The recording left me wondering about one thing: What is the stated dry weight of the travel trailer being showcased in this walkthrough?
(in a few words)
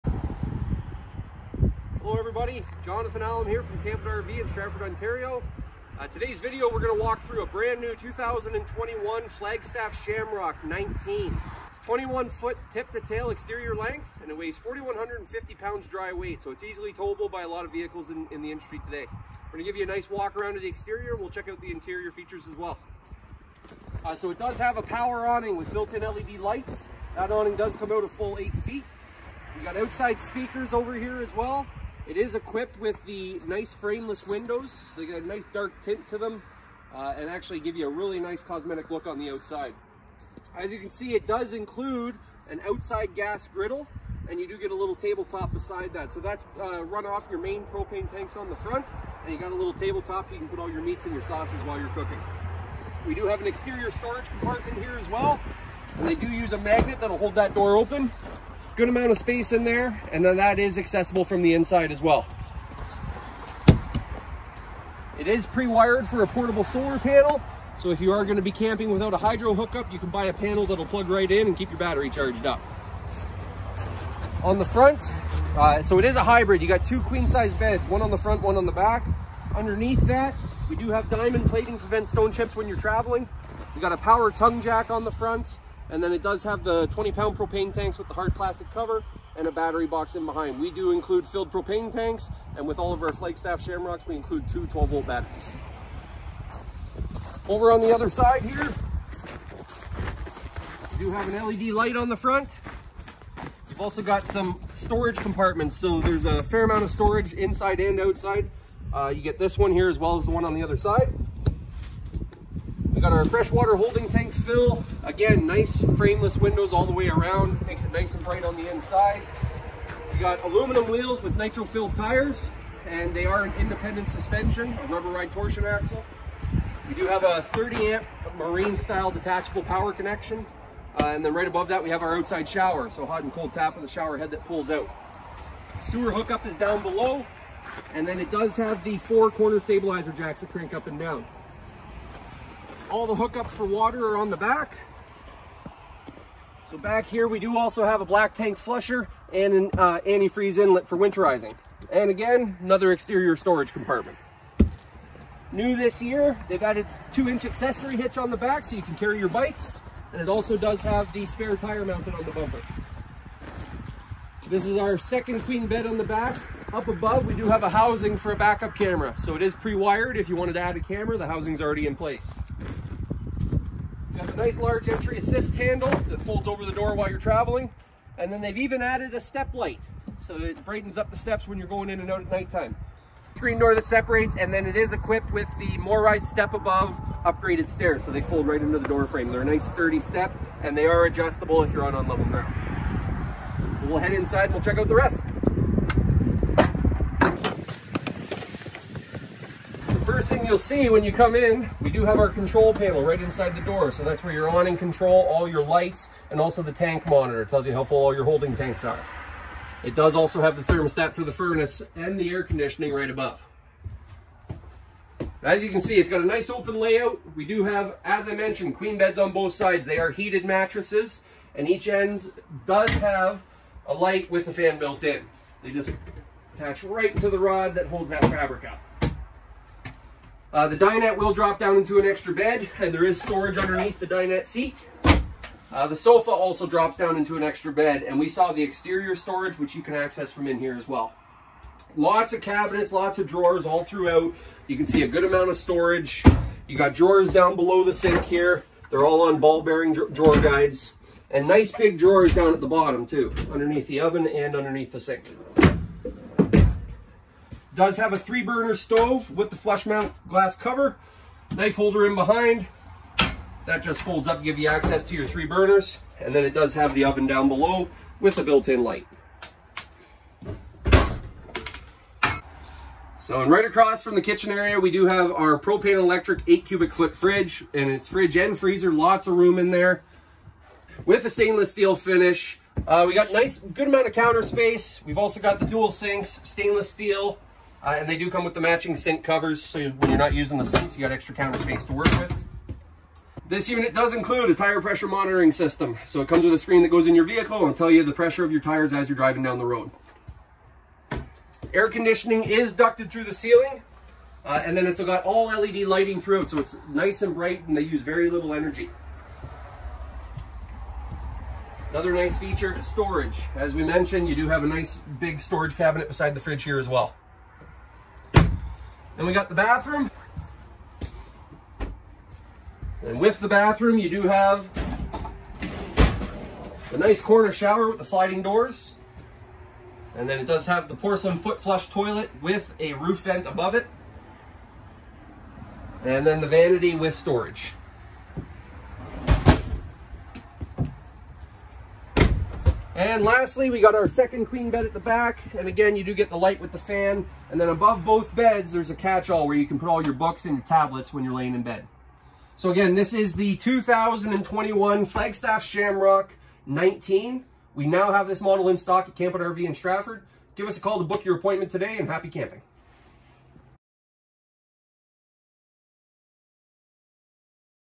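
4,150 pounds.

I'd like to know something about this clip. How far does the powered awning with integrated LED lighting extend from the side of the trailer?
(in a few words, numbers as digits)
8 feet.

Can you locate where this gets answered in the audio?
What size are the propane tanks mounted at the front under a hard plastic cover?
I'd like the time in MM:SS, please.
01:26.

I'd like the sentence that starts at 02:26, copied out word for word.
So back here, we do also have a black tank flusher and an uh, antifreeze inlet for winterizing.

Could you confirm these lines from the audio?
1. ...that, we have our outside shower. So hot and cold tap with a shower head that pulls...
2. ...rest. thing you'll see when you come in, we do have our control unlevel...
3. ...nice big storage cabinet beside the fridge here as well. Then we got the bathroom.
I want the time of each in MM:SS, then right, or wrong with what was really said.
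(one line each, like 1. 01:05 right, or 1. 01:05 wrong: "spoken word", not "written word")
1. 02:11 right
2. 03:14 wrong: "panel", not "unlevel"
3. 05:14 right.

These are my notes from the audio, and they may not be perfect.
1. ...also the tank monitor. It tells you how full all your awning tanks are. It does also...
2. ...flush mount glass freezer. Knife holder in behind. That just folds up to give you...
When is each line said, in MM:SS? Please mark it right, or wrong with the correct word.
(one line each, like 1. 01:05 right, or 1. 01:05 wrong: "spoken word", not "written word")
1. 03:26 wrong: "holding", not "awning"
2. 04:19 wrong: "cover", not "freezer".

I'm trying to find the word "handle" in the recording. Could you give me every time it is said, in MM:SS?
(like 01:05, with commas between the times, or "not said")
02:55.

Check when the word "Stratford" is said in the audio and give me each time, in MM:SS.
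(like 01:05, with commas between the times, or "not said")
00:04, 05:59.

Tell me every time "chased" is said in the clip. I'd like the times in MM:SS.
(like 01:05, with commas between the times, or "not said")
not said.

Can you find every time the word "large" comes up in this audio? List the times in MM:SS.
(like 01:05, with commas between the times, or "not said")
02:54.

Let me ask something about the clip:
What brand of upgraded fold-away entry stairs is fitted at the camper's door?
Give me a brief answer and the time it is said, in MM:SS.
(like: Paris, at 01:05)
MORryde, at 03:05.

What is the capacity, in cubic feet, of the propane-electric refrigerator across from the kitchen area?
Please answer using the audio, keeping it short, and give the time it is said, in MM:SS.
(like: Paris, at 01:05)
8 cubic foot, at 04:36.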